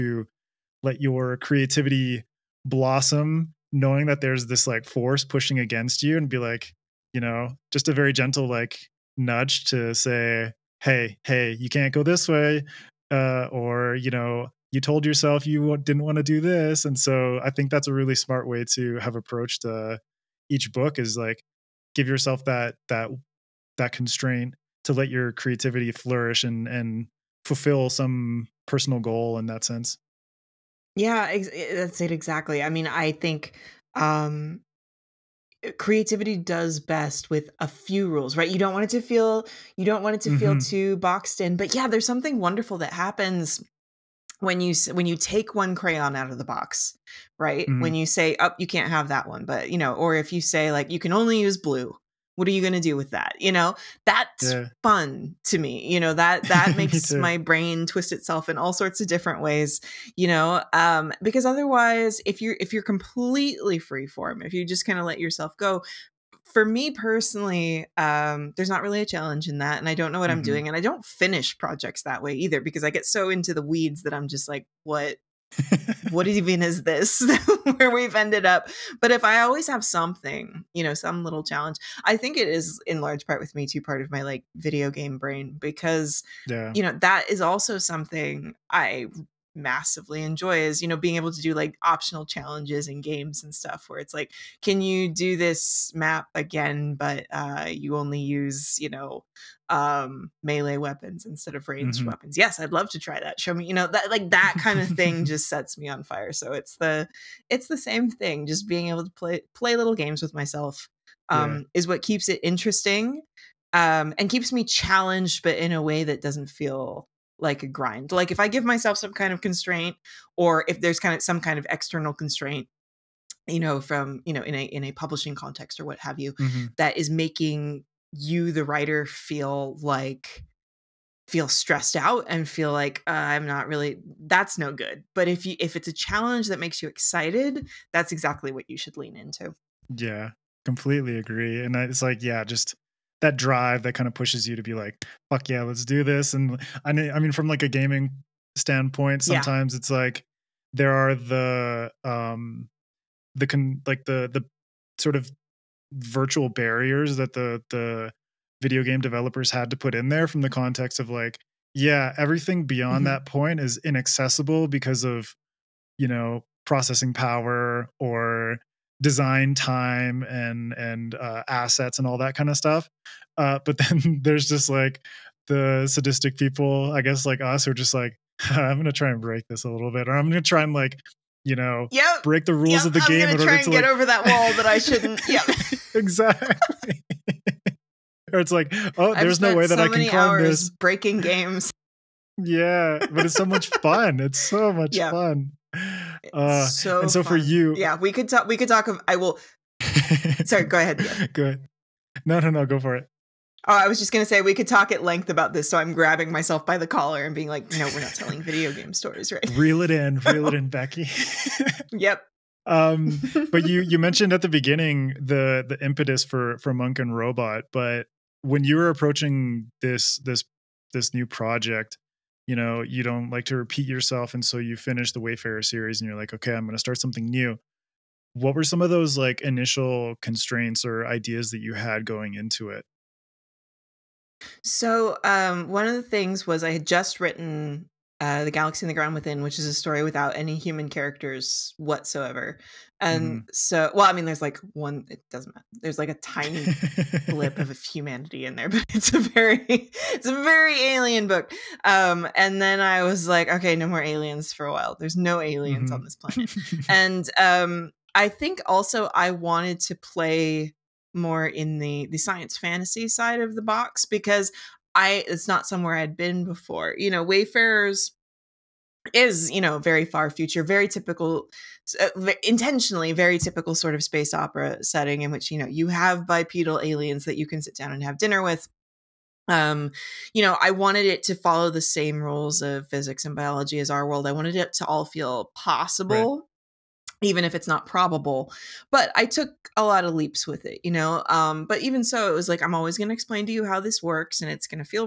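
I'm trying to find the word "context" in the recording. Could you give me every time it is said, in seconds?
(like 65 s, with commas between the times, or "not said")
125 s, 160 s.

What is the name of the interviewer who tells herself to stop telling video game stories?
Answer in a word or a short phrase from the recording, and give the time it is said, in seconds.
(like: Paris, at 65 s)
Becky, at 210 s.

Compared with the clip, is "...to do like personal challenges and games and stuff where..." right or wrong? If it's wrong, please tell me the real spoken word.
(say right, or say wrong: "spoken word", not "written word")
wrong: "optional", not "personal".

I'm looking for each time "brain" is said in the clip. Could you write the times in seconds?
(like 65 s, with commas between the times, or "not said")
57 s, 85 s.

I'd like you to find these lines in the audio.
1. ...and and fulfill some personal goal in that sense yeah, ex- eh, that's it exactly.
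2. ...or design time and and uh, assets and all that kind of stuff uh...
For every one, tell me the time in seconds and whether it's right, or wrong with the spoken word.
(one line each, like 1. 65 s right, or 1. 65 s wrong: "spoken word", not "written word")
1. 26 s right
2. 167 s right.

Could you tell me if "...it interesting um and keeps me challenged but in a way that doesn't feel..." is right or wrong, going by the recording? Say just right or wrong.
right.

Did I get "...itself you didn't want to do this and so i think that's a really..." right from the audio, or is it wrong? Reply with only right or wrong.
wrong.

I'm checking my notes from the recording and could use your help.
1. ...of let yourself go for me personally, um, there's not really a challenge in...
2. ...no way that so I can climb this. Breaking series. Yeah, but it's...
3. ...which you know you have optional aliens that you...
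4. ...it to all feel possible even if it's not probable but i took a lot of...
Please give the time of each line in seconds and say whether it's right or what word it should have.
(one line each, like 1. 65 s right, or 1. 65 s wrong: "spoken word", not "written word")
1. 64 s right
2. 189 s wrong: "games", not "series"
3. 275 s wrong: "bipedal", not "optional"
4. 284 s right.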